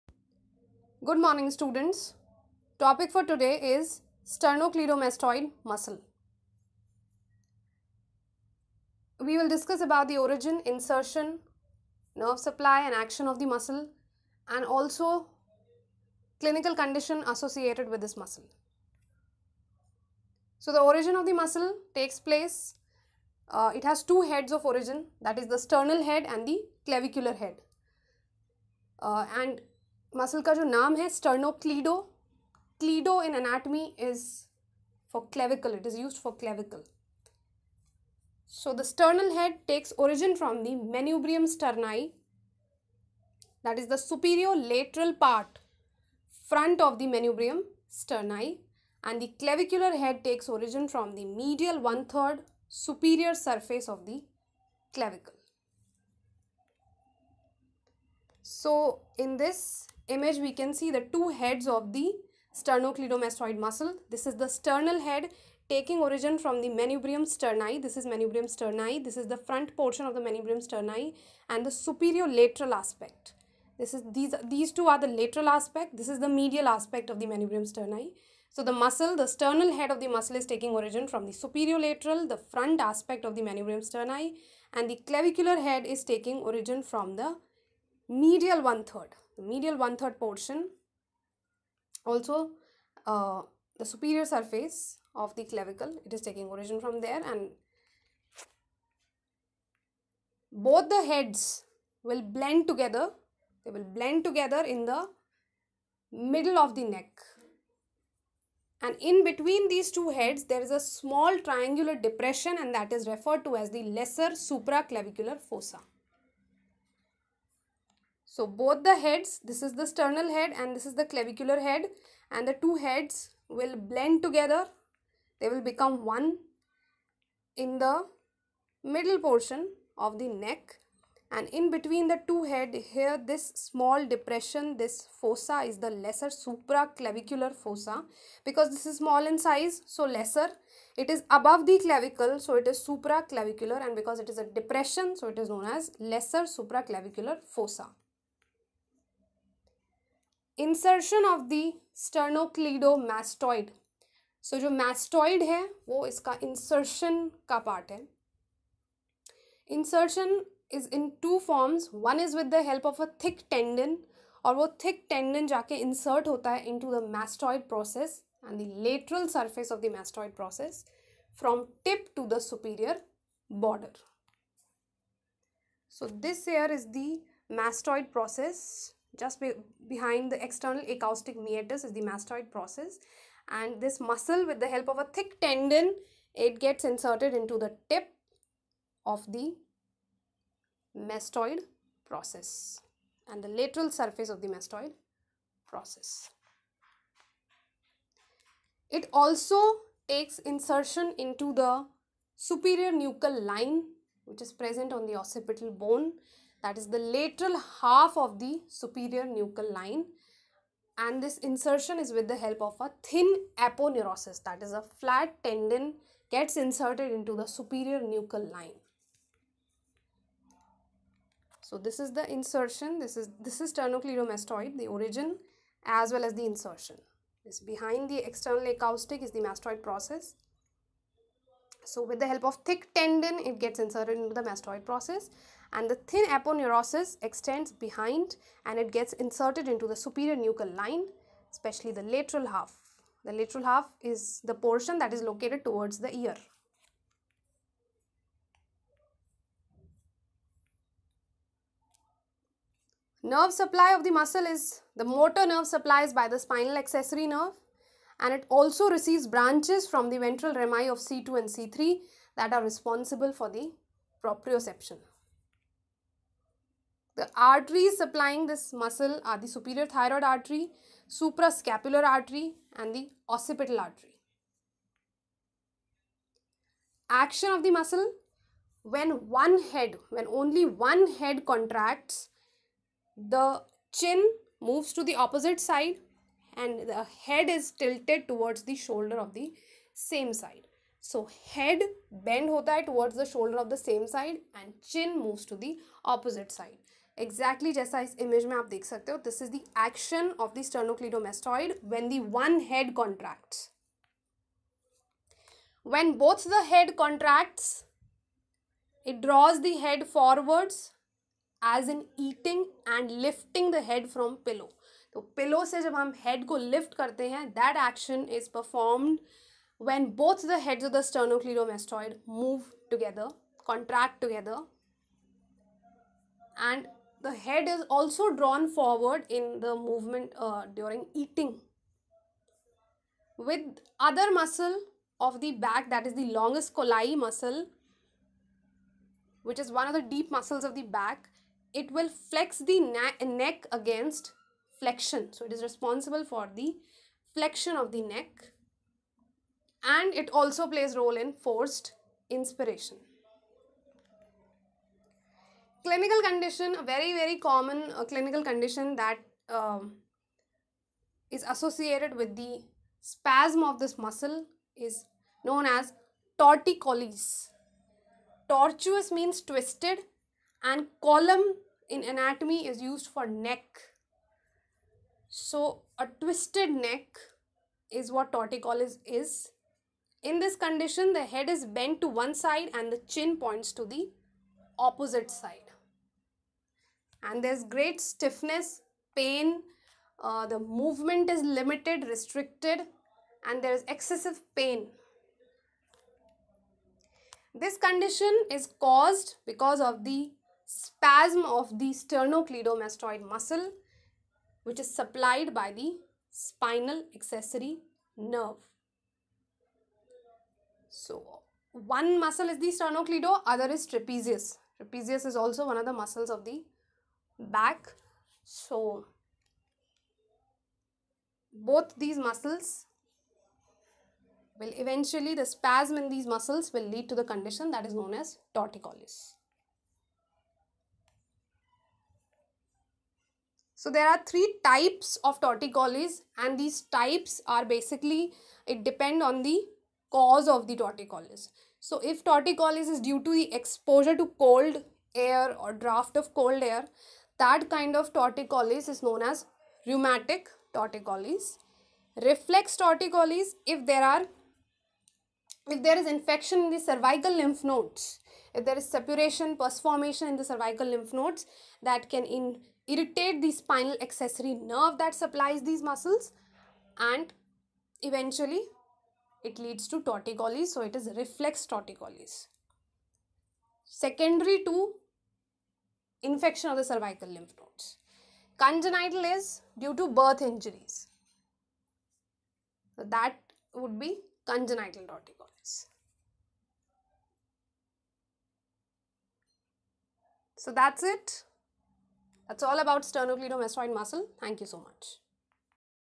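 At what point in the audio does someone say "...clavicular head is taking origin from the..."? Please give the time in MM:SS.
01:25.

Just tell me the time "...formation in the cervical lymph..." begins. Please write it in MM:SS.
07:39.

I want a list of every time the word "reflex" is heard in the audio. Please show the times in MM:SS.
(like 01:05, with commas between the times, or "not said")
07:32, 07:51.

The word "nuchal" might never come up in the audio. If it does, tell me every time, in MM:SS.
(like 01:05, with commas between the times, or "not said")
03:22, 03:29, 03:37, 04:00.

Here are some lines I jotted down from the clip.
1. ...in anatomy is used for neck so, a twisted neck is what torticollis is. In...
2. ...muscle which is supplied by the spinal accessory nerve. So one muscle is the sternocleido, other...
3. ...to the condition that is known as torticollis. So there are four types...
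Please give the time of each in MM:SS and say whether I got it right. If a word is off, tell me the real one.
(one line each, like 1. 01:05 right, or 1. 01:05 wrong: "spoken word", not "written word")
1. 06:11 right
2. 06:43 right
3. 07:07 wrong: "three", not "four".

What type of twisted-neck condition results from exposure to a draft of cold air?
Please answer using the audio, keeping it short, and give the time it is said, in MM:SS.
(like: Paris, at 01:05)
rheumatic torticollis, at 07:29.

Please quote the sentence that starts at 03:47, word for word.
This behind the external acoustic is the mastoid process.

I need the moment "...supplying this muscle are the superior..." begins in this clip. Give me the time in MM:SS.
04:27.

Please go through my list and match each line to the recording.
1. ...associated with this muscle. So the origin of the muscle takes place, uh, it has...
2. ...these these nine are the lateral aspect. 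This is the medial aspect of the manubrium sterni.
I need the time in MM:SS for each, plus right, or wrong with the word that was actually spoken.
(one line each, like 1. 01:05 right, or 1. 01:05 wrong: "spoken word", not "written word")
1. 00:17 right
2. 01:14 wrong: "two", not "nine".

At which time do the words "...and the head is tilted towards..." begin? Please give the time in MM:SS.
04:46.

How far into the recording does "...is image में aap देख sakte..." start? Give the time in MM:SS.
04:58.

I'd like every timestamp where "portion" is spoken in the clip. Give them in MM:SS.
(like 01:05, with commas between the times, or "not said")
01:09, 01:30, 02:09, 04:04.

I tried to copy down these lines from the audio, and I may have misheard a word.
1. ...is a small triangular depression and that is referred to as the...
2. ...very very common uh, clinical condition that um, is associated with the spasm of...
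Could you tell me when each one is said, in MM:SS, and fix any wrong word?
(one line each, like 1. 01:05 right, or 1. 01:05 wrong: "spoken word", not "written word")
1. 01:50 right
2. 05:56 right.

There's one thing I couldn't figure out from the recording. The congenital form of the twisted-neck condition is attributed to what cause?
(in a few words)
birth injuries.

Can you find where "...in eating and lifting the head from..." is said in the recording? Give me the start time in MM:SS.
05:11.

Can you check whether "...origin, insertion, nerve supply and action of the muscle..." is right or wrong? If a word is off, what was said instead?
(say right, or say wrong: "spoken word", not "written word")
right.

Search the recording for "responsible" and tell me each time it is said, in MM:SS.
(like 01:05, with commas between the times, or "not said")
04:22, 05:45.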